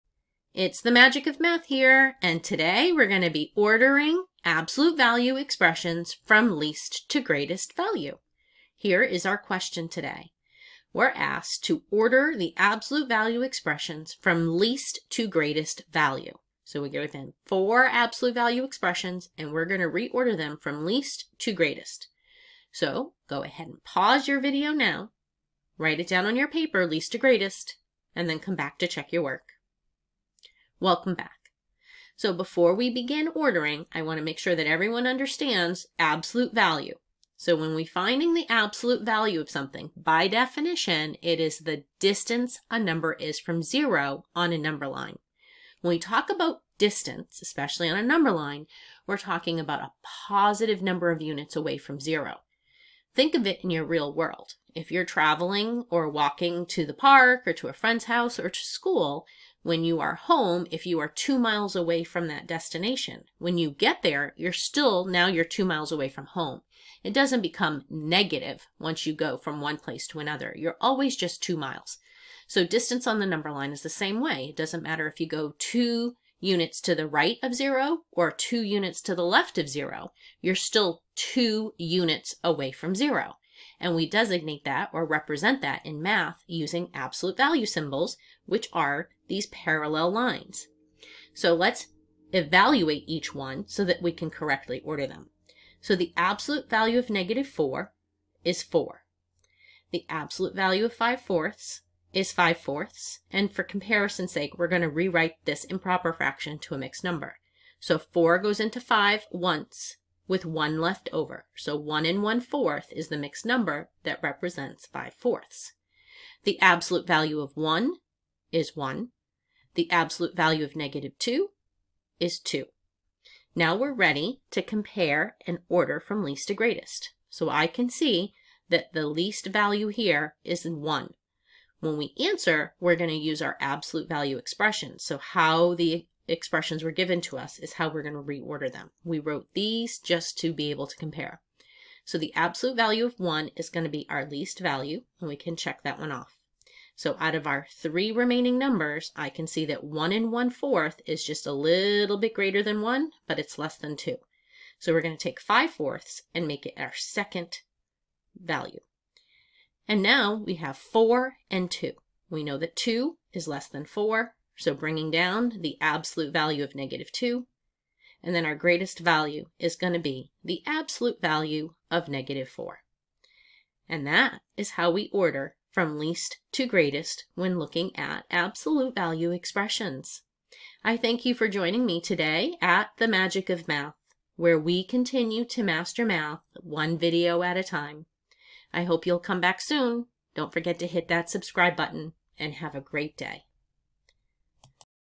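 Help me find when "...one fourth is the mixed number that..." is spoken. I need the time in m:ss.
1:52.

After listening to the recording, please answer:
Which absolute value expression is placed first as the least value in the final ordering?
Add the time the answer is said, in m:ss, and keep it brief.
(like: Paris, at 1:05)
absolute value of 1, at 2:22.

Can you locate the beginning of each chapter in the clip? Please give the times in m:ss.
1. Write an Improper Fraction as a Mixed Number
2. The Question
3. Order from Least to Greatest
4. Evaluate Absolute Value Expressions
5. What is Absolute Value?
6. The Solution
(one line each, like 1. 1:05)
1. 1:45
2. 0:10
3. 2:06
4. 1:32
5. 0:34
6. 2:53.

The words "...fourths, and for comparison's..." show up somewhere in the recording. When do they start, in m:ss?
1:42.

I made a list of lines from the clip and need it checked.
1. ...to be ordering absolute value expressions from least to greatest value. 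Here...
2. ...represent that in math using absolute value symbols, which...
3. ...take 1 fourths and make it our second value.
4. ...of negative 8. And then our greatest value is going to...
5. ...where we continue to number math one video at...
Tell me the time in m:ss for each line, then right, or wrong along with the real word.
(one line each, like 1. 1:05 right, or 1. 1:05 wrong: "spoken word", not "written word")
1. 0:03 right
2. 1:25 right
3. 2:35 wrong: "5", not "1"
4. 2:46 wrong: "2", not "8"
5. 3:04 wrong: "master", not "number".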